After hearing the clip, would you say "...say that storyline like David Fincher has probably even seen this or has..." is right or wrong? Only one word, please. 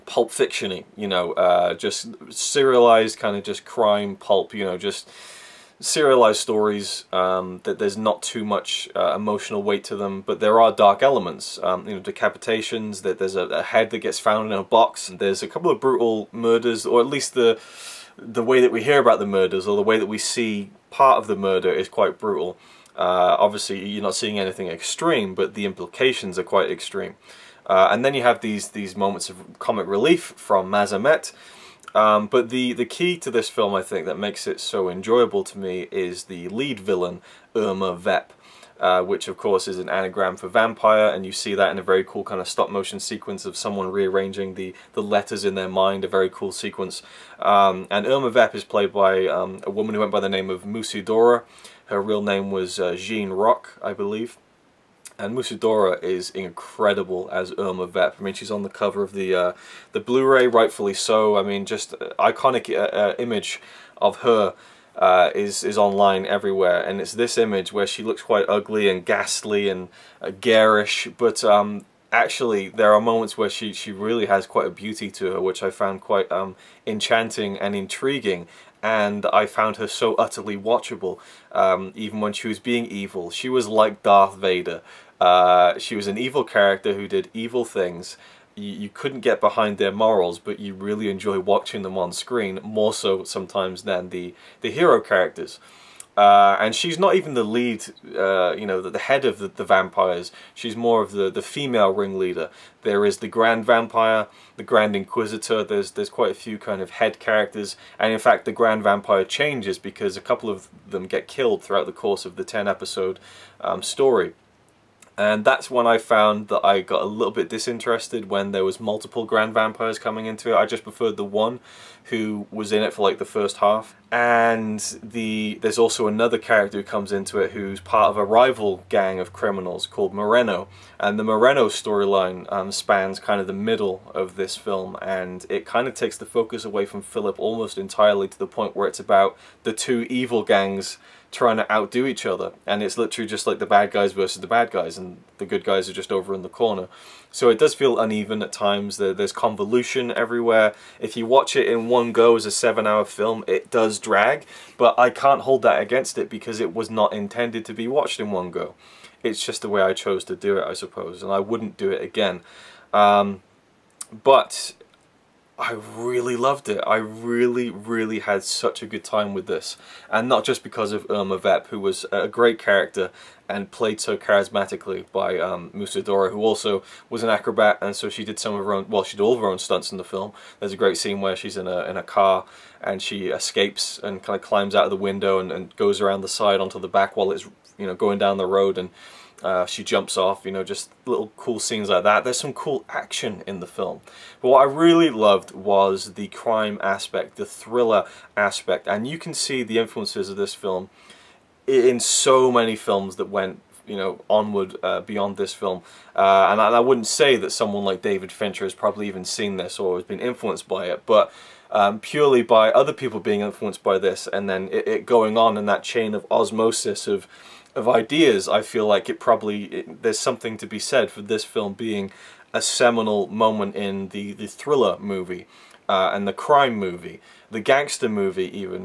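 wrong.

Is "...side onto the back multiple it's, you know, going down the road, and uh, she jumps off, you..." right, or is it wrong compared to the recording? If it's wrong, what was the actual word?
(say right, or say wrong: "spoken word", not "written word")
wrong: "while", not "multiple".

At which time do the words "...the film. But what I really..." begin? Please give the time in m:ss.
3:13.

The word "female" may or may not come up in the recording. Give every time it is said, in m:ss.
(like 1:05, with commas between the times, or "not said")
1:41.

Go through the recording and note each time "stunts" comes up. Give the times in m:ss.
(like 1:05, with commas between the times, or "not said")
2:59.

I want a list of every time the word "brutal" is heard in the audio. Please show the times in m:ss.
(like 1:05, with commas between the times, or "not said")
0:15, 0:22.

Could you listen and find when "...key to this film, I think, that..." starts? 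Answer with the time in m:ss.
0:32.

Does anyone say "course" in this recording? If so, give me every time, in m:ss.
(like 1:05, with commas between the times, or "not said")
0:39, 1:51.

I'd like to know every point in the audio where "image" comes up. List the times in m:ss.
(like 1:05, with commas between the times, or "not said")
1:03, 1:07.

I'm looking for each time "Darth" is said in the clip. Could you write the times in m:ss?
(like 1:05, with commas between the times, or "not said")
1:24.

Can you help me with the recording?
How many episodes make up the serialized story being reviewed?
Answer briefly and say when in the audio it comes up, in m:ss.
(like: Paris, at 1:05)
10, at 1:52.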